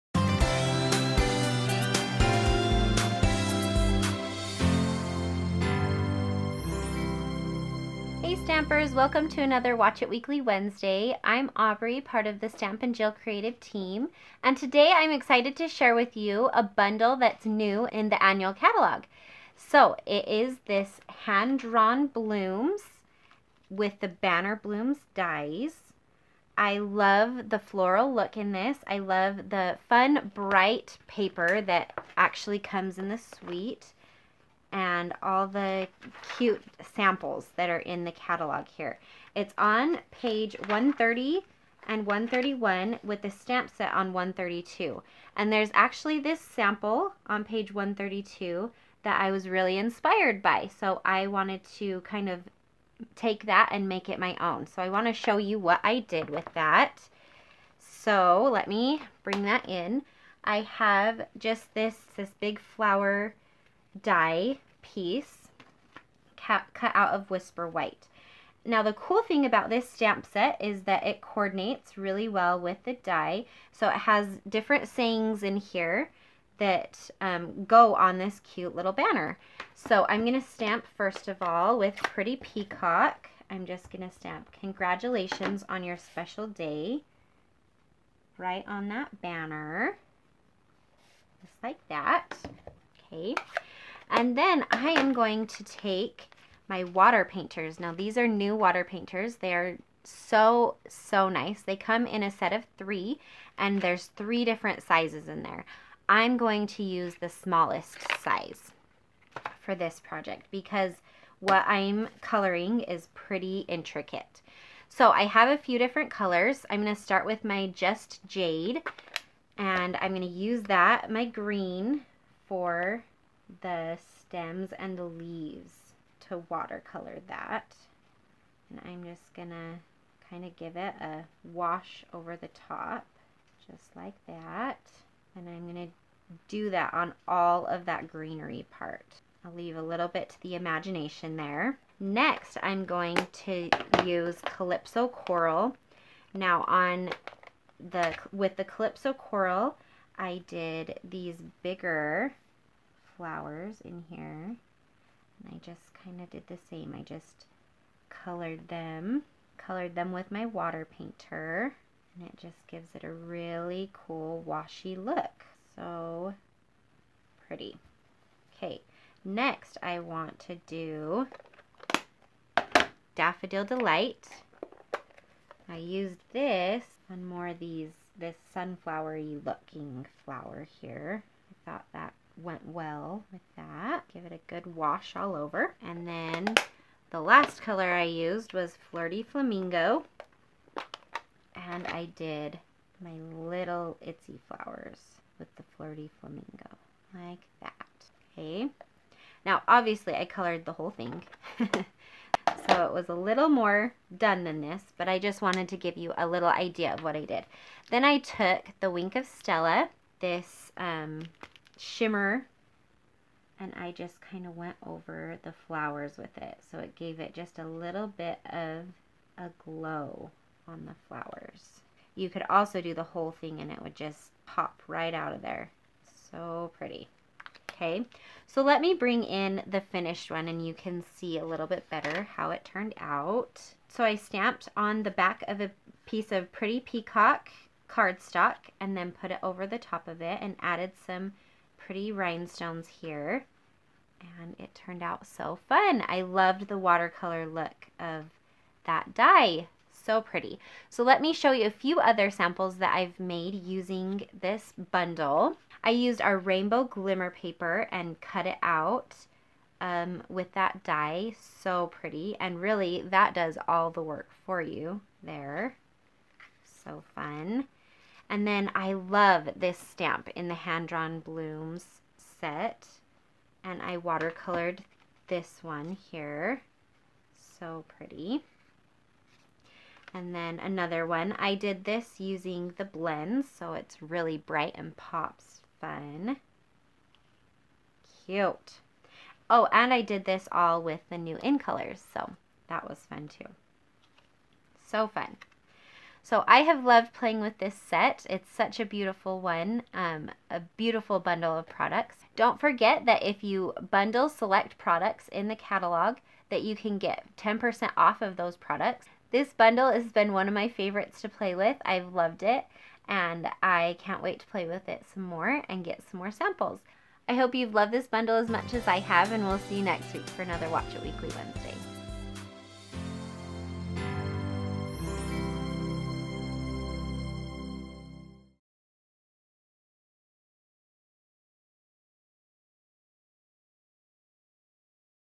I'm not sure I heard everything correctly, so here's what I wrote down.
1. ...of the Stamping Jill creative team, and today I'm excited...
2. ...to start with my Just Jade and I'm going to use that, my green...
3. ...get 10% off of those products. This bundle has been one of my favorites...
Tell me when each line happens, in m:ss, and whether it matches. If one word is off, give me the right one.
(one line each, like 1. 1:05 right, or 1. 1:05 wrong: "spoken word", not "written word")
1. 0:12 right
2. 1:56 right
3. 5:06 right.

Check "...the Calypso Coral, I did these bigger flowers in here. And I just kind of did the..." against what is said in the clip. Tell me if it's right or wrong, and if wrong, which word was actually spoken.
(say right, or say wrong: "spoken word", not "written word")
right.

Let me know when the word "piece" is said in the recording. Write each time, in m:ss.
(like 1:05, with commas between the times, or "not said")
1:04, 3:56.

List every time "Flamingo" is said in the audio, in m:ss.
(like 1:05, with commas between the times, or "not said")
3:09, 3:16.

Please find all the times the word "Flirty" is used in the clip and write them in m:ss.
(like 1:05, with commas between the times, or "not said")
3:08, 3:15.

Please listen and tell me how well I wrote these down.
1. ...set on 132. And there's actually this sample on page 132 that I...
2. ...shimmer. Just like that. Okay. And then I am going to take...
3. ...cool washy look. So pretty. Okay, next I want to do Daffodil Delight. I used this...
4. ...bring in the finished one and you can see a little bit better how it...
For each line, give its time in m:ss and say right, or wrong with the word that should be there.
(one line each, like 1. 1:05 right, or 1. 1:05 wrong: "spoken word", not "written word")
1. 0:43 right
2. 1:29 wrong: "banner", not "shimmer"
3. 2:43 right
4. 3:48 right.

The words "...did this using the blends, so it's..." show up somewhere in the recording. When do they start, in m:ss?
4:41.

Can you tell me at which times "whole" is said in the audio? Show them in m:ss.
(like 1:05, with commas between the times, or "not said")
3:20, 3:43.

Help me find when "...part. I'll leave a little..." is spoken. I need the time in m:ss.
2:18.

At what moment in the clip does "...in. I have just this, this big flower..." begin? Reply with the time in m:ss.
0:59.